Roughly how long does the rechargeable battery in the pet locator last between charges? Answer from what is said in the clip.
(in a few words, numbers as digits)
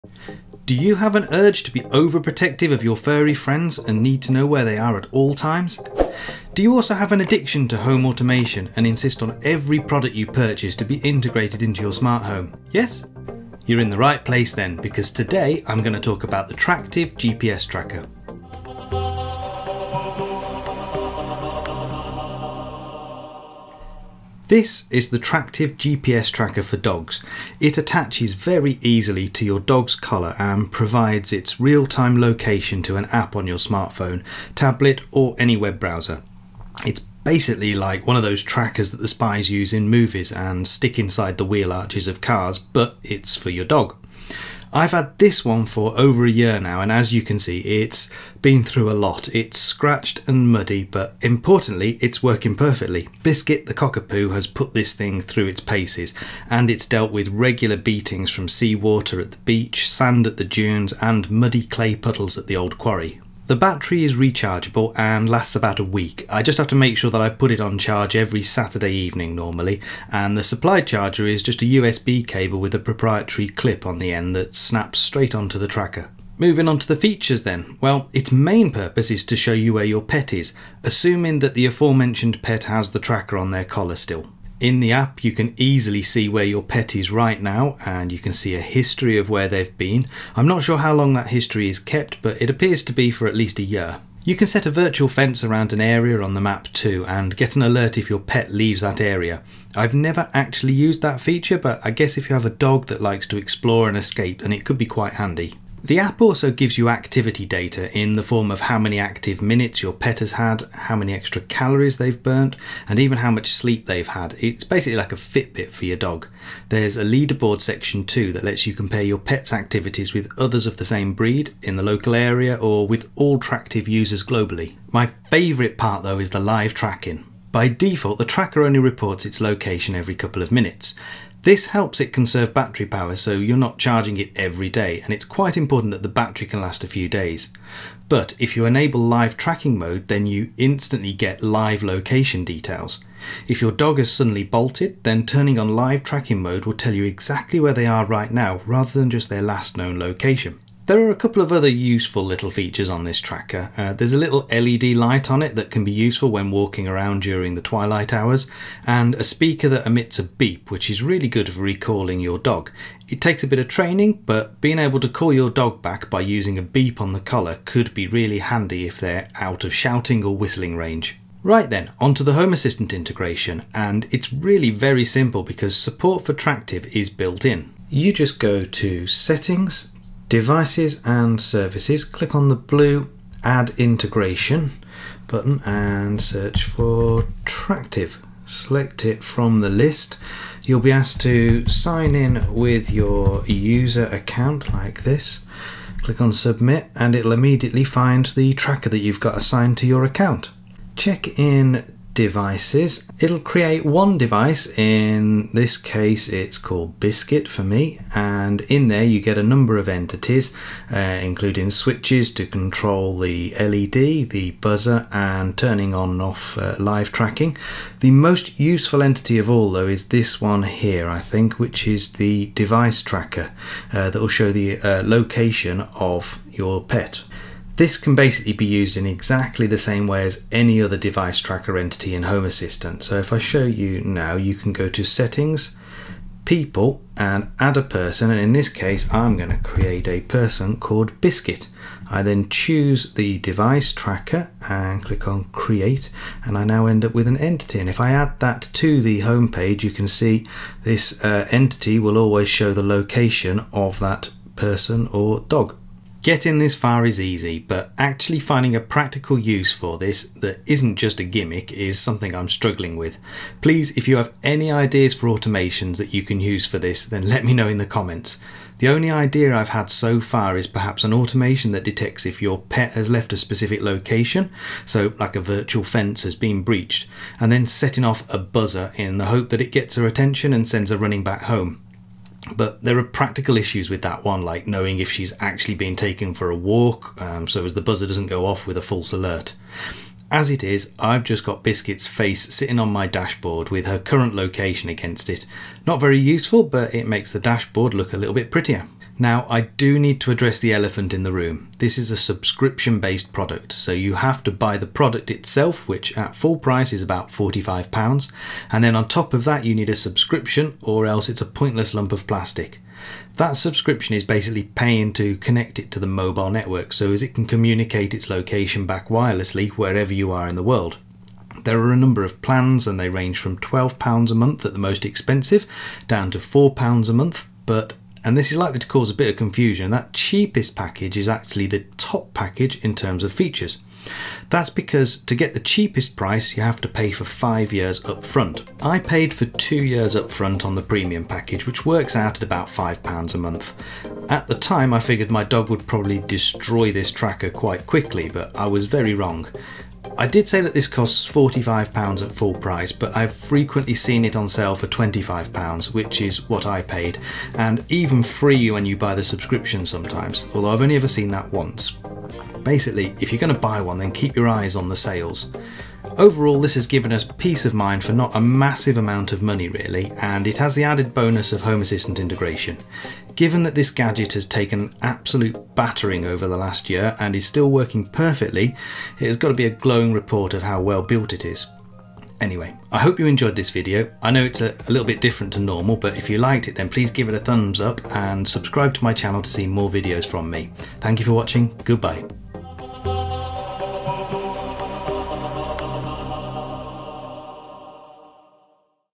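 About a week.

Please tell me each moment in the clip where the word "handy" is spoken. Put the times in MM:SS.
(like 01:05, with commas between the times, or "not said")
01:45, 02:48.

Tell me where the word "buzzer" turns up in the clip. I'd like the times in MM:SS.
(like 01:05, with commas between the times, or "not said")
03:34, 04:38, 04:47.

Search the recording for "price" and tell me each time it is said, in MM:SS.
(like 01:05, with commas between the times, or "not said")
05:06, 05:36, 05:52.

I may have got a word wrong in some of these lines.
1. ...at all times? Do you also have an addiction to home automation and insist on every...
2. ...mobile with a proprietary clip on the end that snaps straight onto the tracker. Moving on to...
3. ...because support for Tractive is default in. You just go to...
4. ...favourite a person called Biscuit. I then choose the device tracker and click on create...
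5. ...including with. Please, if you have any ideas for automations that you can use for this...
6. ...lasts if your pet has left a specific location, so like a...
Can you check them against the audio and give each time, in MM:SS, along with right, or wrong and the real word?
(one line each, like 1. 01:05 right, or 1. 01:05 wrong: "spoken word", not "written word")
1. 00:04 right
2. 01:12 wrong: "cable", not "mobile"
3. 02:55 wrong: "built", not "default"
4. 03:59 wrong: "create", not "favourite"
5. 04:22 wrong: "struggling", not "including"
6. 04:31 wrong: "detects", not "lasts".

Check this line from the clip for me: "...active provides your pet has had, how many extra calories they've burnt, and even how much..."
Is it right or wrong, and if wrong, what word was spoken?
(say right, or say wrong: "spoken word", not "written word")
wrong: "minutes", not "provides".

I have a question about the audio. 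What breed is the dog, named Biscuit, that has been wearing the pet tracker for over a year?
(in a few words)
Cockapoo.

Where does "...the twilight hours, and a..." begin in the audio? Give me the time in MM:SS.
02:37.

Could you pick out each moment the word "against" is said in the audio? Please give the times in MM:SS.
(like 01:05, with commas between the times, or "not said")
04:54.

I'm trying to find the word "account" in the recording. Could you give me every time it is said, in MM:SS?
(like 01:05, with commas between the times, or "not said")
03:14, 03:20.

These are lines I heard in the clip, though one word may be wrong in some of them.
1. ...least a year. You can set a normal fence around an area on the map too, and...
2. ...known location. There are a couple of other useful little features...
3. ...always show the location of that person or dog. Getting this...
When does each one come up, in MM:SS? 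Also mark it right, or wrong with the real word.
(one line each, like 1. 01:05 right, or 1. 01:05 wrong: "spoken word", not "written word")
1. 01:33 wrong: "virtual", not "normal"
2. 02:29 right
3. 04:12 right.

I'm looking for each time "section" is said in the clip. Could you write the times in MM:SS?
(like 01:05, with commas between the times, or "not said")
01:57.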